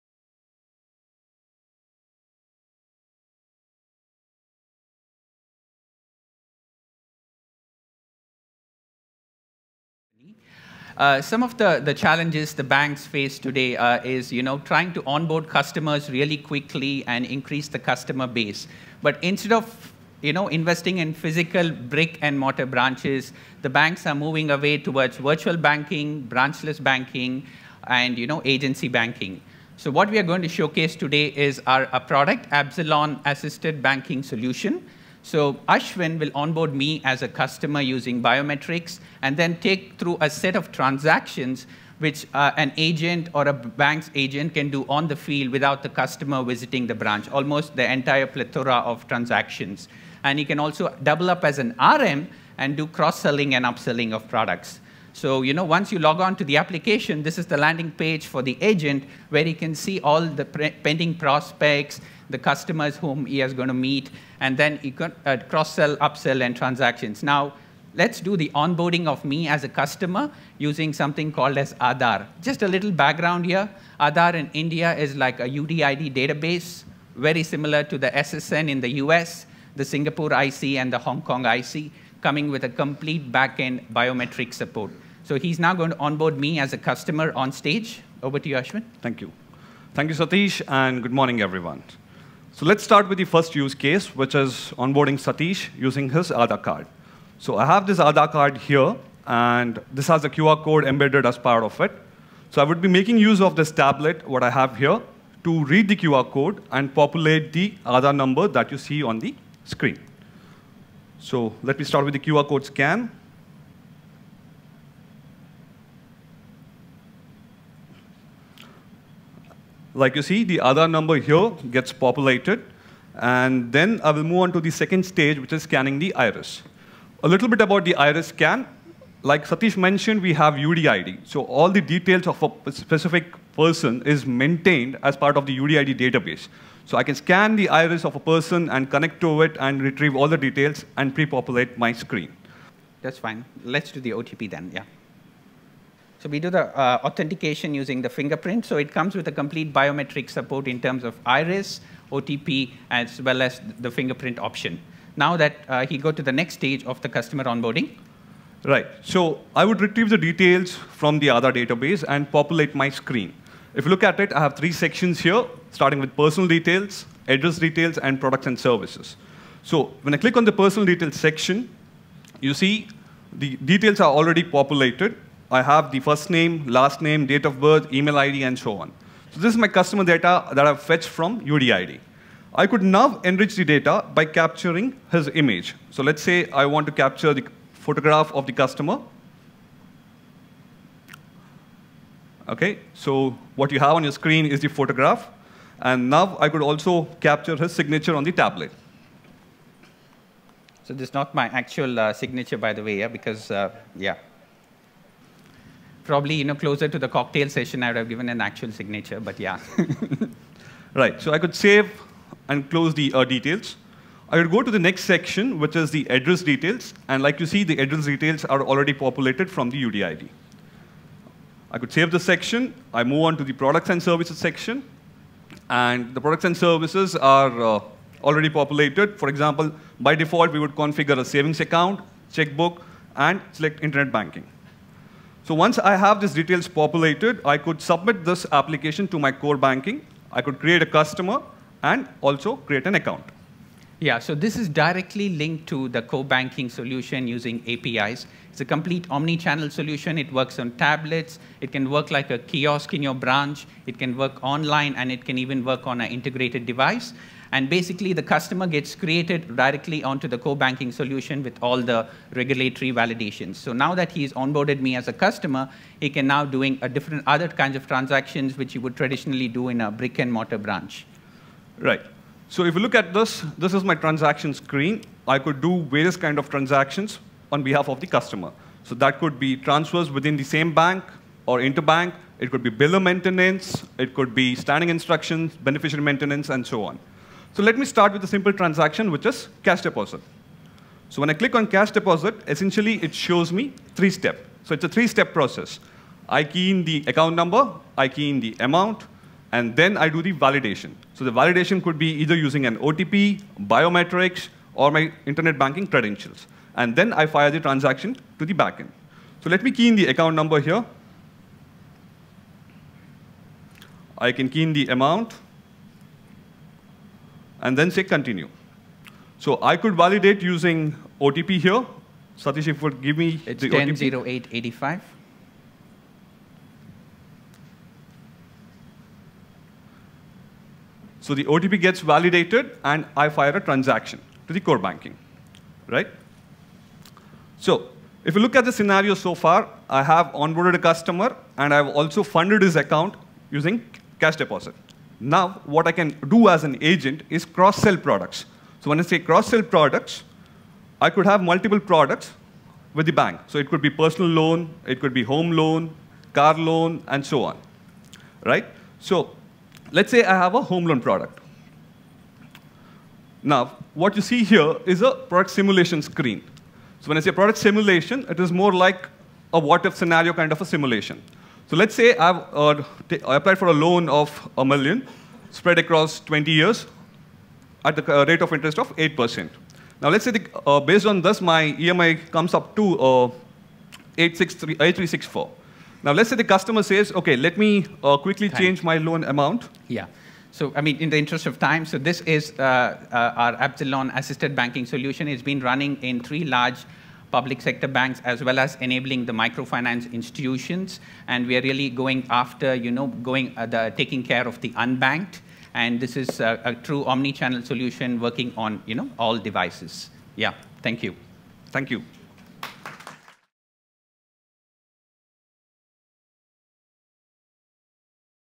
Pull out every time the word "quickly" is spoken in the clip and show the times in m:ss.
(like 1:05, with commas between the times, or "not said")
0:16, 6:28.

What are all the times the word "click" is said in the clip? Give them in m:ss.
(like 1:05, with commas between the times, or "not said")
2:50, 4:51.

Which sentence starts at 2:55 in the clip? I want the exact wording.
I have the first name, last name, date of birth, email ID, and so on.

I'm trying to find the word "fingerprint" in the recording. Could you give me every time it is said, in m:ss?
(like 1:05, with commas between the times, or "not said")
2:28, 2:33.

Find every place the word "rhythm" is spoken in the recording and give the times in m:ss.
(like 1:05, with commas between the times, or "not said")
not said.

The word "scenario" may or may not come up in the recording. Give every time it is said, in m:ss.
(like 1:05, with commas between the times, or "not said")
5:38, 6:09.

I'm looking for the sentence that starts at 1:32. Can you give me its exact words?
So let's start with the first use case, which is onboarding Satish using his Aadhaar card.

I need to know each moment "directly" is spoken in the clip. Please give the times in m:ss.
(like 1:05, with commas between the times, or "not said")
4:04, 4:19.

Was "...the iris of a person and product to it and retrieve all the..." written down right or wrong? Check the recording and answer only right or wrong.
wrong.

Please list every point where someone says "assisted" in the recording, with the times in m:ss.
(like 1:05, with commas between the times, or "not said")
0:33, 6:34.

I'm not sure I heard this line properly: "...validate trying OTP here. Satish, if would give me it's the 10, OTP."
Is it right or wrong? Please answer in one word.
wrong.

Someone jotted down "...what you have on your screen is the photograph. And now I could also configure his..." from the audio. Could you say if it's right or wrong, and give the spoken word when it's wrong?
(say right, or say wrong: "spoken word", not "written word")
wrong: "capture", not "configure".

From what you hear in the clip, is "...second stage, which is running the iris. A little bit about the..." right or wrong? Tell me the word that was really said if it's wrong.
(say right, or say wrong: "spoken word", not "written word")
wrong: "scanning", not "running".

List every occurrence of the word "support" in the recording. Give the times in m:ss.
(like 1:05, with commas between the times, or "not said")
1:24, 2:30.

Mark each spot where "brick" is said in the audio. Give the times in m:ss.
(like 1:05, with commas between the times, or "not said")
0:21, 4:29.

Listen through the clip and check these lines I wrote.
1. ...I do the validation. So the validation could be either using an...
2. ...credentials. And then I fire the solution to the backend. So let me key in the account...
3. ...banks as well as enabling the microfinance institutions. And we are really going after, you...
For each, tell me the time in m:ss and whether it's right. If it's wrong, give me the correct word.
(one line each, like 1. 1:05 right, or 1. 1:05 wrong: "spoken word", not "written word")
1. 4:59 right
2. 5:05 wrong: "transaction", not "solution"
3. 6:37 right.